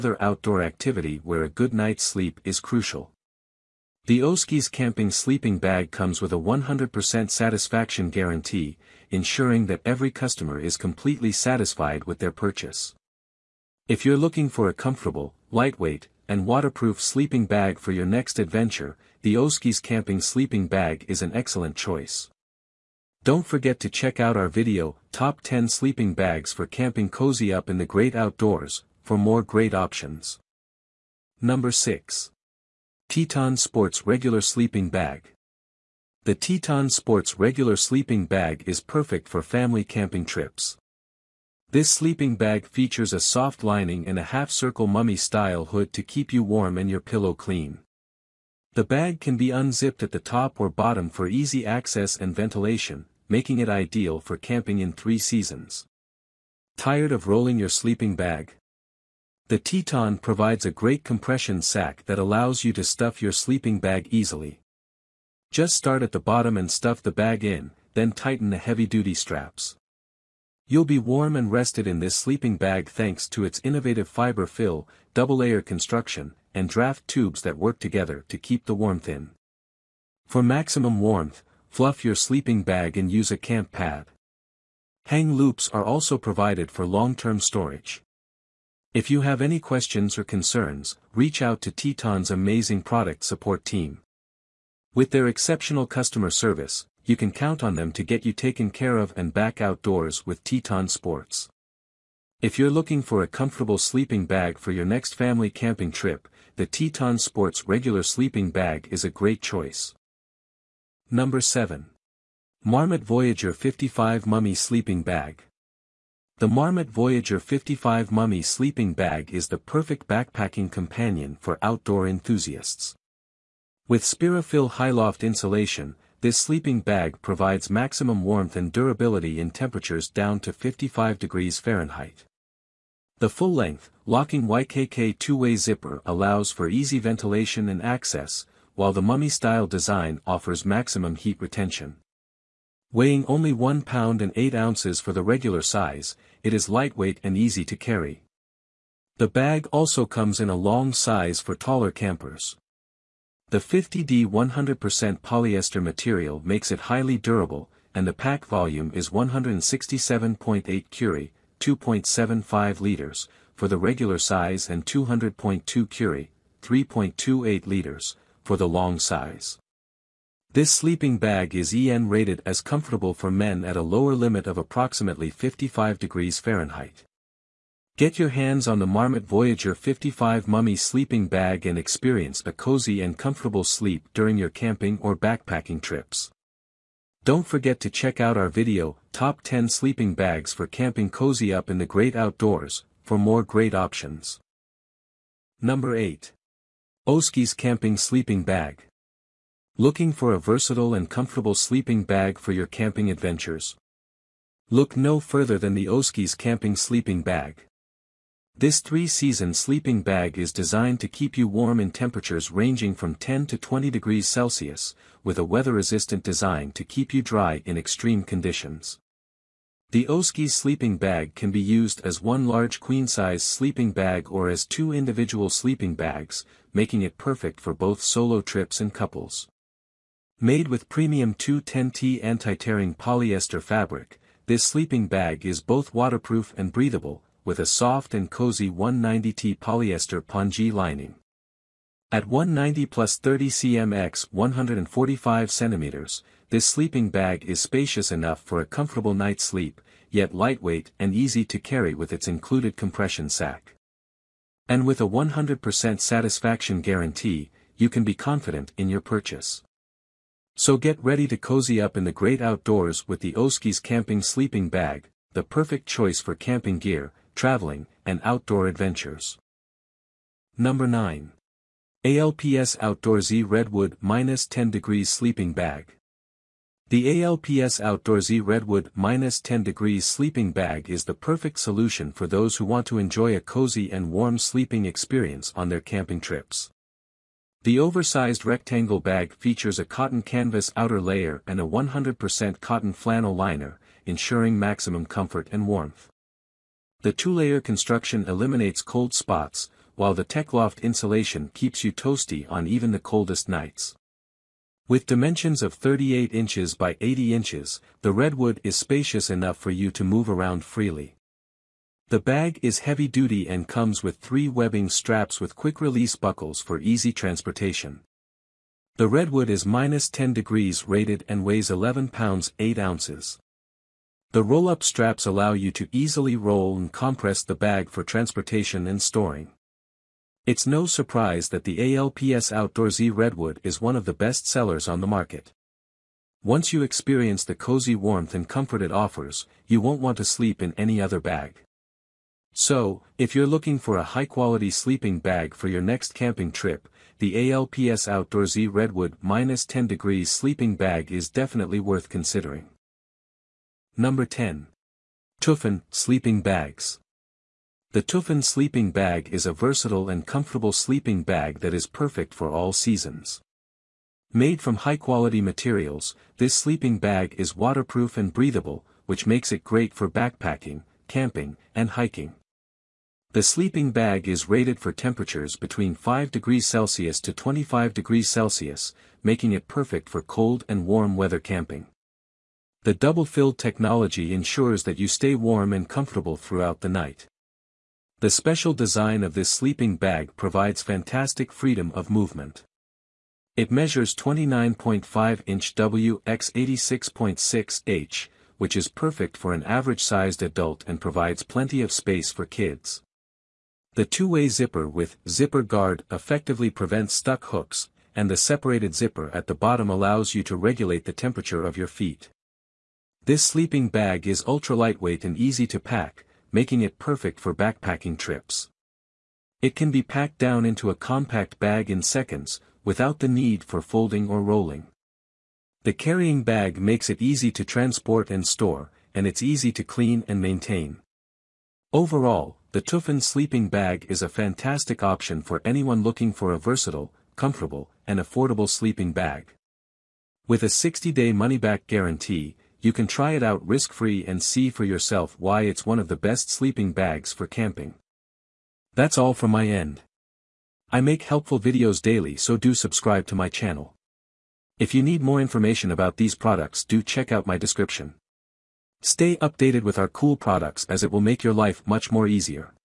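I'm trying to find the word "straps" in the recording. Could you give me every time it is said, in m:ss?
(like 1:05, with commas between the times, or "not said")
1:09, 5:14, 5:24.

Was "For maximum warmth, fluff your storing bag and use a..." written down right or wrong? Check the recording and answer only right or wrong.
wrong.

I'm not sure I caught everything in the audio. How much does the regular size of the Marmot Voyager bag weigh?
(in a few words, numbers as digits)
1 pound and 8 ounces.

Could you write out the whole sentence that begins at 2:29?
The bag also comes in a long size for taller campers.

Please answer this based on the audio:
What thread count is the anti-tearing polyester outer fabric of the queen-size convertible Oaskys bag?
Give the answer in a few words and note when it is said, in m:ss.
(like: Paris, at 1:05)
210T, at 3:51.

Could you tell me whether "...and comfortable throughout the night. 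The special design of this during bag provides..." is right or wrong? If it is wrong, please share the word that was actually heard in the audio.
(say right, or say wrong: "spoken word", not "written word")
wrong: "sleeping", not "during".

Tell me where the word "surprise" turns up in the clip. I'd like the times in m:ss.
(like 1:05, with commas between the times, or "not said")
5:30.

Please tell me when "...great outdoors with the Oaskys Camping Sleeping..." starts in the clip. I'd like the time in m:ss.
4:22.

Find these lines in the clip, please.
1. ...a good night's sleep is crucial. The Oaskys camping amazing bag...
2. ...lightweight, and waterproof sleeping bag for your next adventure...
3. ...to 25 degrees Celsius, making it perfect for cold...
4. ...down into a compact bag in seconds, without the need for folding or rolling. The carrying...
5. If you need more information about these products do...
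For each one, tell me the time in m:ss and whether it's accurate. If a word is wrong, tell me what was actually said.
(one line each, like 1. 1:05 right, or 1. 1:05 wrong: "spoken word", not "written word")
1. 0:01 wrong: "sleeping", not "amazing"
2. 0:15 right
3. 6:17 right
4. 7:00 right
5. 7:34 right.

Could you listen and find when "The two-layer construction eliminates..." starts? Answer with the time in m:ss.
4:57.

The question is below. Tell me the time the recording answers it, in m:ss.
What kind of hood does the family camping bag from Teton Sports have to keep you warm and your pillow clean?
0:44.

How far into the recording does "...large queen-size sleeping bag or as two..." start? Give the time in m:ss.
3:42.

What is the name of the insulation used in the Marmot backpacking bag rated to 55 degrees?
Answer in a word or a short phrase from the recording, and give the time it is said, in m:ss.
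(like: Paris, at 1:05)
Spirafil Loft, at 2:04.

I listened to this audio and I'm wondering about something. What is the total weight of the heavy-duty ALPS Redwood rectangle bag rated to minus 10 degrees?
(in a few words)
11 pounds 8 ounces.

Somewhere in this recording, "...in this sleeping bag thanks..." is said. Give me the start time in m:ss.
1:11.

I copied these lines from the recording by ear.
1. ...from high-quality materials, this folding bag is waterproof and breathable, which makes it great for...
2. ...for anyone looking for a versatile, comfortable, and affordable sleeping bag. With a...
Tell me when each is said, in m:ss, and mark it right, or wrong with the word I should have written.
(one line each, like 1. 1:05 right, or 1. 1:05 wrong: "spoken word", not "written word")
1. 6:04 wrong: "sleeping", not "folding"
2. 7:15 right.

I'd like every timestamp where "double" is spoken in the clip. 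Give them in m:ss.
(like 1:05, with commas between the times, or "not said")
1:15, 6:22.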